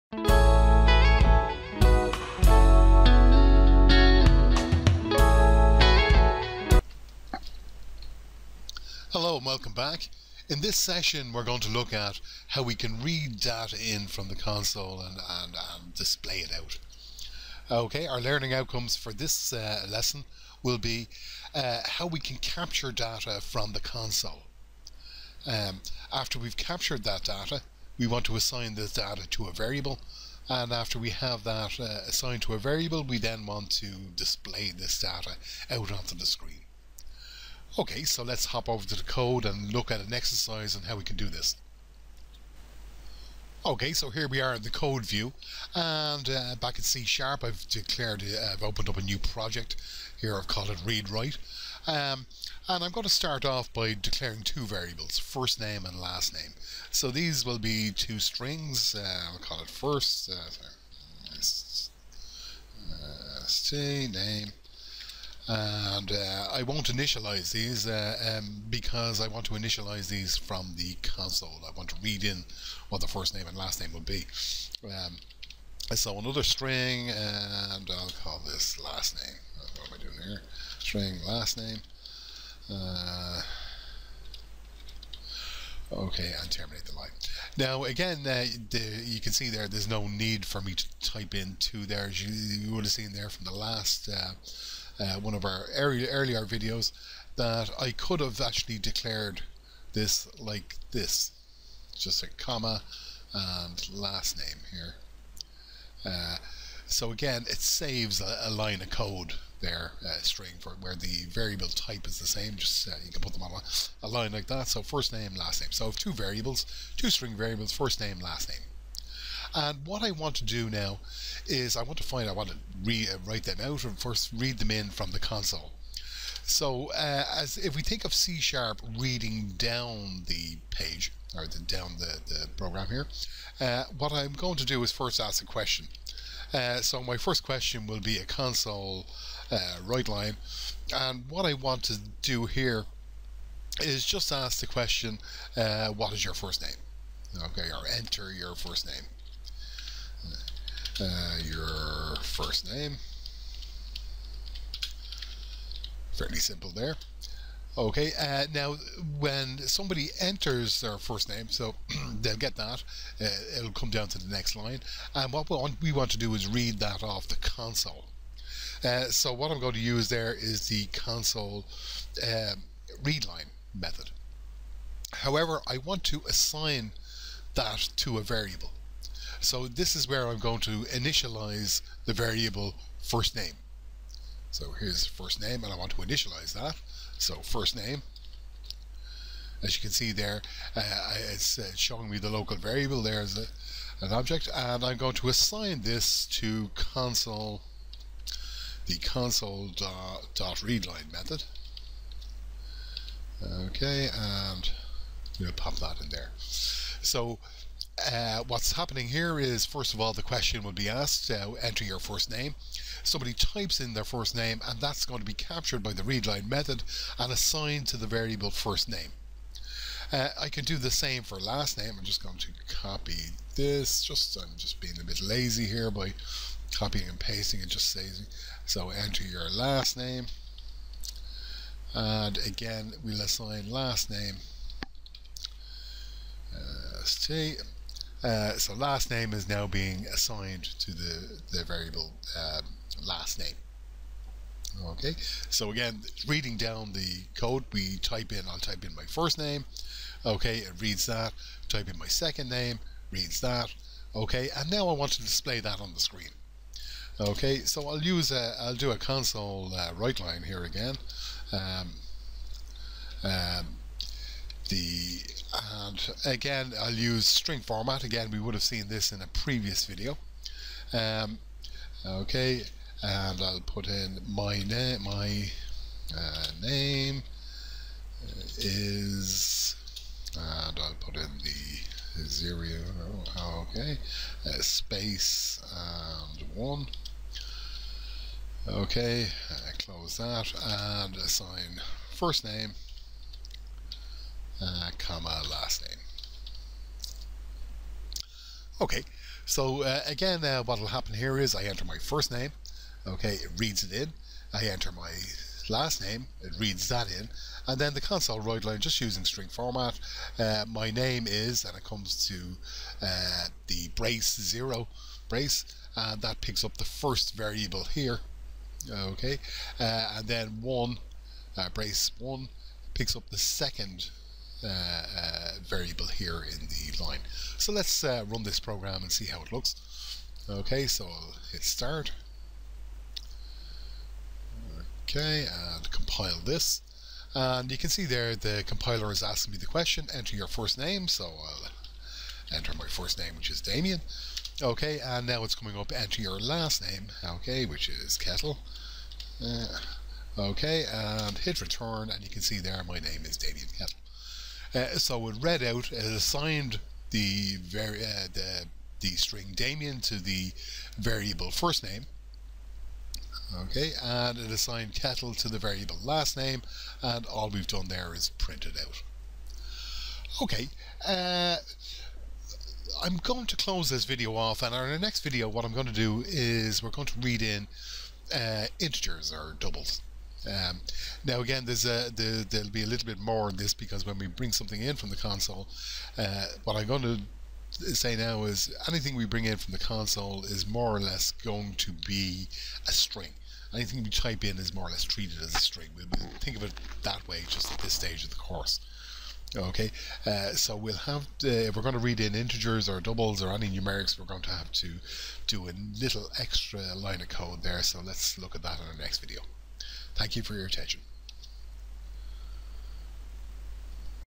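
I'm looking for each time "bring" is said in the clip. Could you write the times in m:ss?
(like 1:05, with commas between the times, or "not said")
6:24, 6:29.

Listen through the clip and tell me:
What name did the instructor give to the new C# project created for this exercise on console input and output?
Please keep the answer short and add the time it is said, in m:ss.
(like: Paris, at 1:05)
Read Write, at 0:50.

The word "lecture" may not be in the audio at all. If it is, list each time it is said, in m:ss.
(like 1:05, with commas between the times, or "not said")
not said.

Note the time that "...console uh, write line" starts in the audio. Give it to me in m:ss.
2:18.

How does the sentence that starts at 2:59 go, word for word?
So this is where I'm going to initialize the variable first name.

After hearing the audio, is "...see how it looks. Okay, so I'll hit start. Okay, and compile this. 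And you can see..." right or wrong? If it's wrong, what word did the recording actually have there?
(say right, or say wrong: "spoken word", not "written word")
right.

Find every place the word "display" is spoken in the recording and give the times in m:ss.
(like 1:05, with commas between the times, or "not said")
0:15, 0:34, 4:15.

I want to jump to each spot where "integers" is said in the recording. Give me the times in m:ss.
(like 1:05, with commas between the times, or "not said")
6:18, 6:42.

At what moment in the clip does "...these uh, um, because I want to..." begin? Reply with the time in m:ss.
1:07.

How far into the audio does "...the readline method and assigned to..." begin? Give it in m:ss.
3:35.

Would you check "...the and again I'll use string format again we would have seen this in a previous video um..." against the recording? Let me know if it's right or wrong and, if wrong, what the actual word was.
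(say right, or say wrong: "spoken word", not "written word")
right.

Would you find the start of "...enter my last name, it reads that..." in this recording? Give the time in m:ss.
5:04.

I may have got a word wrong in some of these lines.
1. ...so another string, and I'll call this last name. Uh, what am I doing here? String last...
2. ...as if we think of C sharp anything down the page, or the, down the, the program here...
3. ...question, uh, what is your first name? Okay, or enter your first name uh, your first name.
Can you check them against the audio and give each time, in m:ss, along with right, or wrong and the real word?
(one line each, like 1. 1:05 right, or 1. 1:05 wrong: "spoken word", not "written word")
1. 1:15 right
2. 2:07 wrong: "reading", not "anything"
3. 2:24 right.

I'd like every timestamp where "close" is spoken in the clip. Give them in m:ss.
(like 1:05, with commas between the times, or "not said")
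4:49, 6:13.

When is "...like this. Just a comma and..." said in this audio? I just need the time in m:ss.
1:40.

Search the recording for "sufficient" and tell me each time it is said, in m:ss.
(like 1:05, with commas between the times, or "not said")
not said.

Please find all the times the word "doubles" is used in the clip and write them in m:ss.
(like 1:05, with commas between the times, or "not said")
6:19, 6:43.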